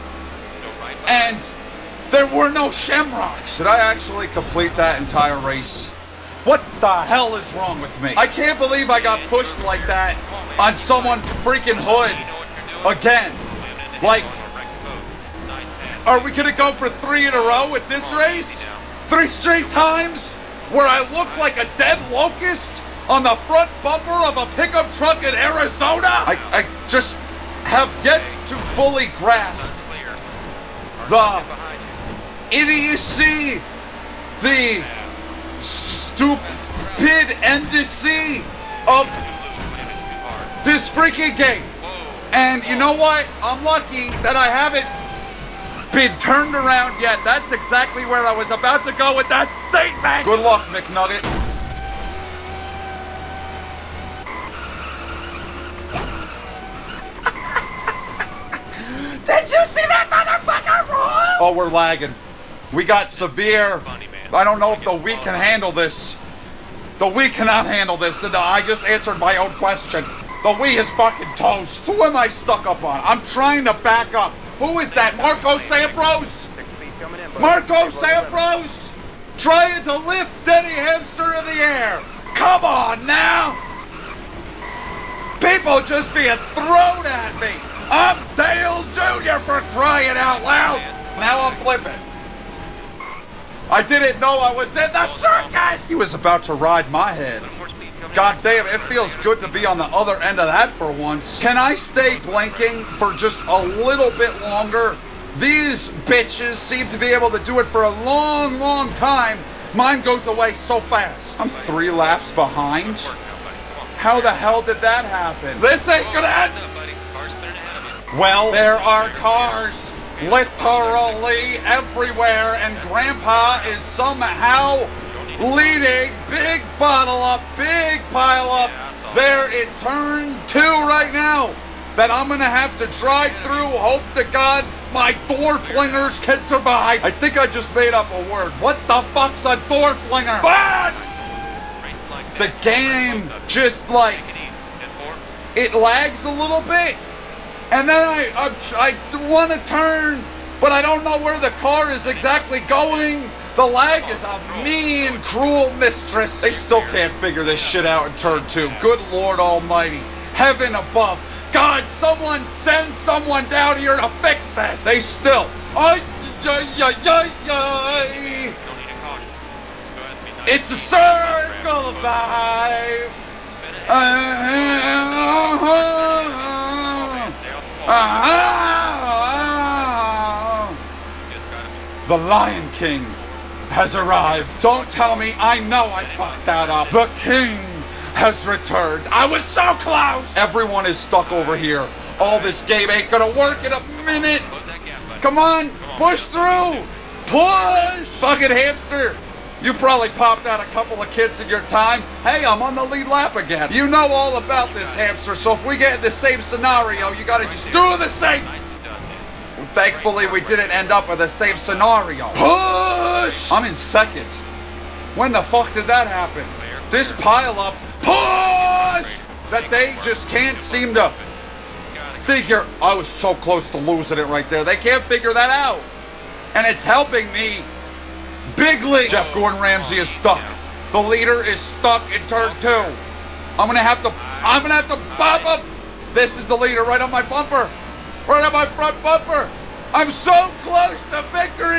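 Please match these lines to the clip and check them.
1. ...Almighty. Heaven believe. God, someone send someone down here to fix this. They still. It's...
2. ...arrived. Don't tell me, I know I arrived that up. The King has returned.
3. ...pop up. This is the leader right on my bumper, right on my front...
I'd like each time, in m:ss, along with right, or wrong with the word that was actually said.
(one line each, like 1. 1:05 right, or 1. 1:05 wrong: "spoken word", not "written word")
1. 2:39 wrong: "above", not "believe"
2. 3:03 wrong: "fucked", not "arrived"
3. 3:55 right.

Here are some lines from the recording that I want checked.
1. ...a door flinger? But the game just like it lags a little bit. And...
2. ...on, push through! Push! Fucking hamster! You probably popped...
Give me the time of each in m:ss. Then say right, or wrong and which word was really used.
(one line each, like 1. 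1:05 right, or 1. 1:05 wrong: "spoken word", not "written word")
1. 2:19 right
2. 3:15 right.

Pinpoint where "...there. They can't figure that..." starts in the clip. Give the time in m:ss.
3:44.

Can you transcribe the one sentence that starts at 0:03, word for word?
Did I actually complete that entire race?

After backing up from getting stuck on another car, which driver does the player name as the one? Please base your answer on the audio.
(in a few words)
Marcos Ambrose.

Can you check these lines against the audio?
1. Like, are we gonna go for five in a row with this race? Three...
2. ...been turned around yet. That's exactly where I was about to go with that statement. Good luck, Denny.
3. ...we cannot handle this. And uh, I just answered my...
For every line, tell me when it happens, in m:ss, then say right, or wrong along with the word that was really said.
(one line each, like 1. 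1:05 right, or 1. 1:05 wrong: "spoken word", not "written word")
1. 0:14 wrong: "three", not "five"
2. 0:45 wrong: "McNugget", not "Denny"
3. 1:07 right.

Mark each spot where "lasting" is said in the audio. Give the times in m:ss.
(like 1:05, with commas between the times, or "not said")
not said.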